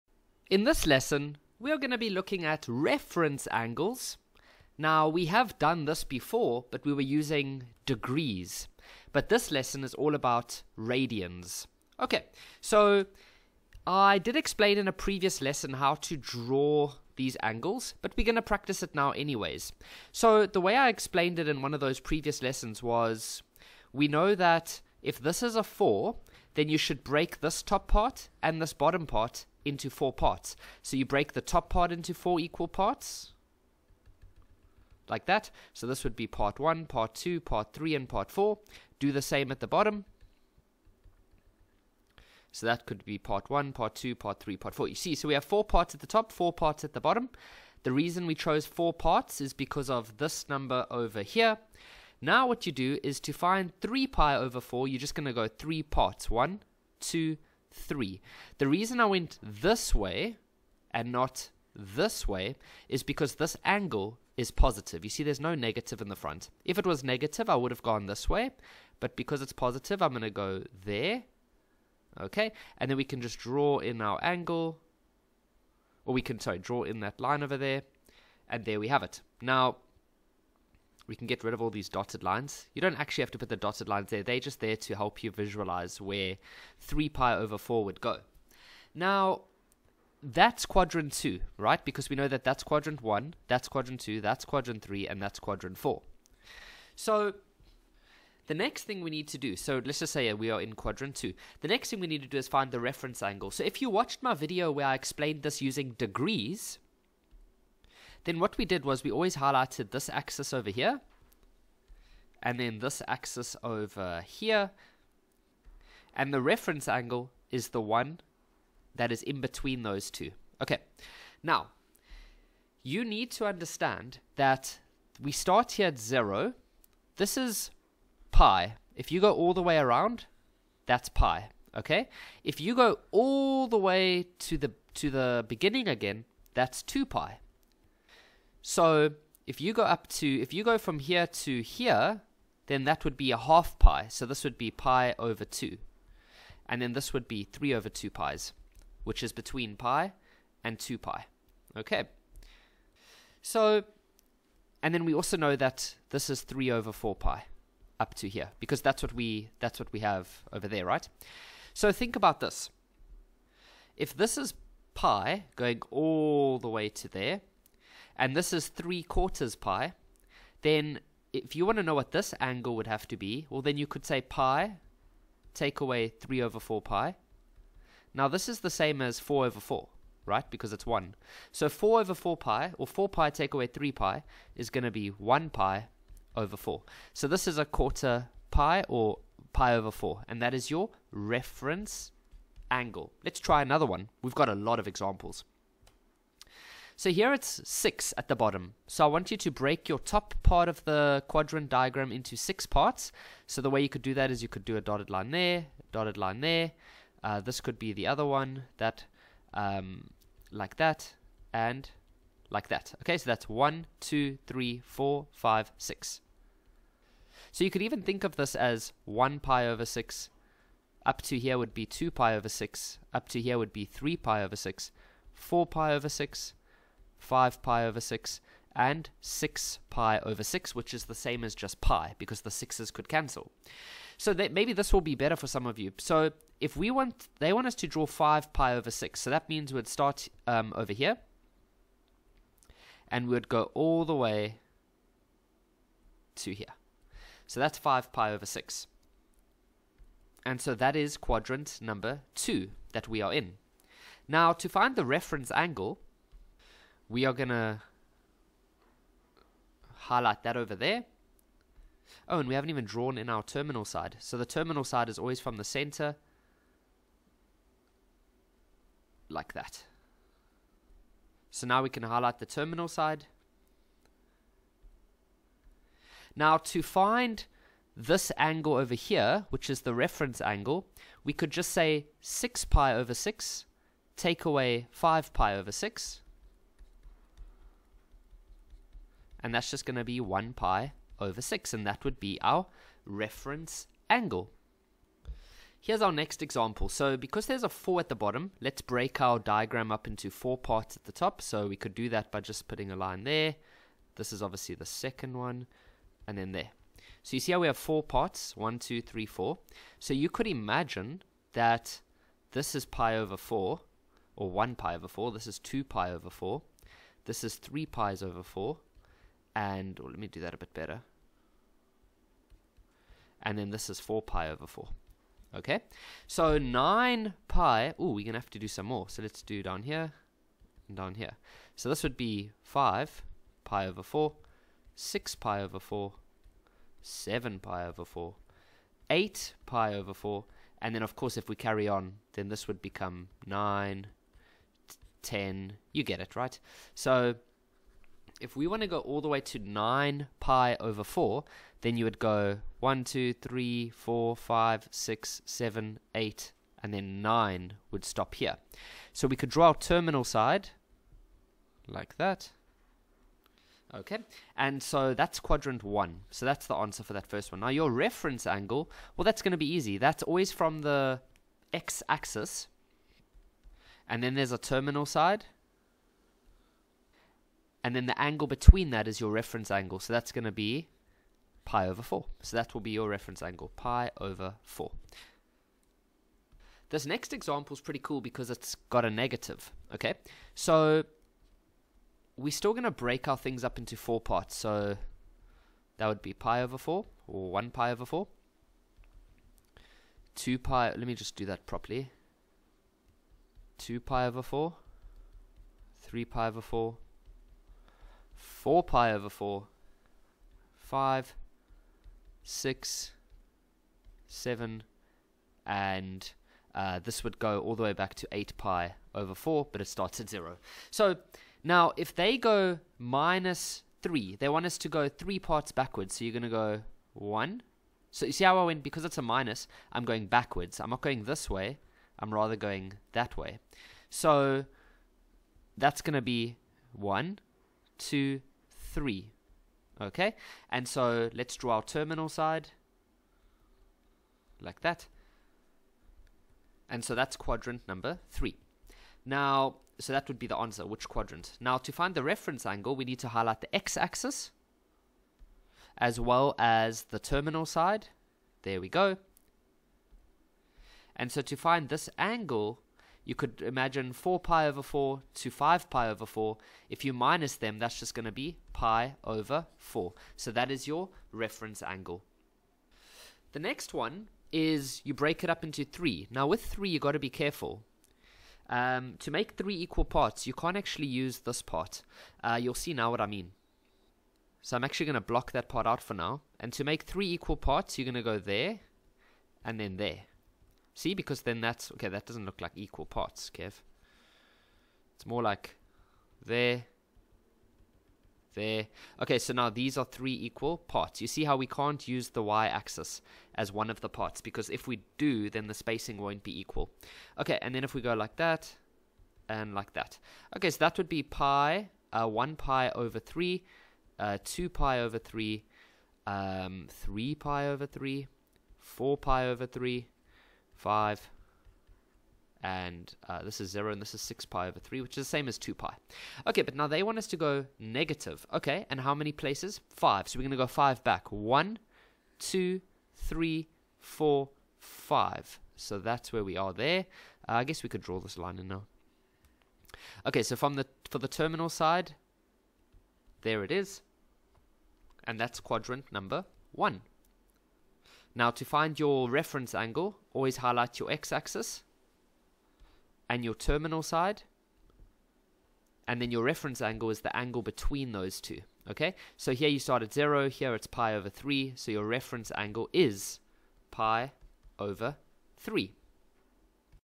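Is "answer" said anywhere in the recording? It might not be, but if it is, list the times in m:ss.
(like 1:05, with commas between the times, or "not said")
6:06, 7:30.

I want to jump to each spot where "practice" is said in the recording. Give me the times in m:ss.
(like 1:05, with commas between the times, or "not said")
0:18.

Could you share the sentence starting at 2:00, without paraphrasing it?
Okay, now you need to understand that we start here at zero.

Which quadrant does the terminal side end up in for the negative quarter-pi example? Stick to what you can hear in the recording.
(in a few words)
Quadrant 3.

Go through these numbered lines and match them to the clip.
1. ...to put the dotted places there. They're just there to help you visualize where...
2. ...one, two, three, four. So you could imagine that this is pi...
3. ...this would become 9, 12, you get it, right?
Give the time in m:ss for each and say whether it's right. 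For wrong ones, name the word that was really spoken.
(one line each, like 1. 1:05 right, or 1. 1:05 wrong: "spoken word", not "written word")
1. 1:23 wrong: "lines", not "places"
2. 5:08 right
3. 5:42 wrong: "10", not "12".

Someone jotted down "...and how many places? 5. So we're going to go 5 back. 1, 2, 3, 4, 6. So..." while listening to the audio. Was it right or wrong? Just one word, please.
wrong.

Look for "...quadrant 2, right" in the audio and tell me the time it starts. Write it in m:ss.
1:30.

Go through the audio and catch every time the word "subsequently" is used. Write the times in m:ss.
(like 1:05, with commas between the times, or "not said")
not said.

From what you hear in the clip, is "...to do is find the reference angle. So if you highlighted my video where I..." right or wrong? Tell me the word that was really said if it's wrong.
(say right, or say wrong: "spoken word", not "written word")
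wrong: "watched", not "highlighted".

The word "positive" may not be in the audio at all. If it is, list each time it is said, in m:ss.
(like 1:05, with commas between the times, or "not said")
1:04, 1:09.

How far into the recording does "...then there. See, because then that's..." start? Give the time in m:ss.
8:09.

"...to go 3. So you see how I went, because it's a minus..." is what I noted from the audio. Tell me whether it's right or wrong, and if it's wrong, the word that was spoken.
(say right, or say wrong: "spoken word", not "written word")
wrong: "1", not "3".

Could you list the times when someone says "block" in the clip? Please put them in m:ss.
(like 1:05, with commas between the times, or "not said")
8:05.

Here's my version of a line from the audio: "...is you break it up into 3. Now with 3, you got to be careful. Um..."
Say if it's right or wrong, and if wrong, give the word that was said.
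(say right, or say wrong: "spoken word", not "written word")
right.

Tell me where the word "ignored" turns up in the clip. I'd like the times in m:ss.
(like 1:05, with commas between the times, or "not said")
not said.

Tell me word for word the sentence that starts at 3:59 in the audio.
So that means we'd start um, over here.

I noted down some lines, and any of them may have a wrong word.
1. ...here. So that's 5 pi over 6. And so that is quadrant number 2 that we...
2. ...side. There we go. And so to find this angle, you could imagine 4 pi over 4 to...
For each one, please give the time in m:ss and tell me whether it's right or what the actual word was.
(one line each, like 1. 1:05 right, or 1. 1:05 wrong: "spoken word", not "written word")
1. 4:06 right
2. 7:37 right.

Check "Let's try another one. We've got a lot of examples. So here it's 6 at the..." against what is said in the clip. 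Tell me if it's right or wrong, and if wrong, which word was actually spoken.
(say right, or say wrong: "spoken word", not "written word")
right.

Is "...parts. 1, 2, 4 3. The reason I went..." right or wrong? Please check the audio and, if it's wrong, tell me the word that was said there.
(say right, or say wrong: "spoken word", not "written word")
wrong: "3", not "4".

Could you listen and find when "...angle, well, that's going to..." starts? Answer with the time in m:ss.
6:08.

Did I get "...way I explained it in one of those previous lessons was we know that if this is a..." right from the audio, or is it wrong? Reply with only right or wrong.
right.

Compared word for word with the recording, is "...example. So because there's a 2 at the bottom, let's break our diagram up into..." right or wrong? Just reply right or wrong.
wrong.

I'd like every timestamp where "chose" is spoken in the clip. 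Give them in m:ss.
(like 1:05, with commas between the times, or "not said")
0:48.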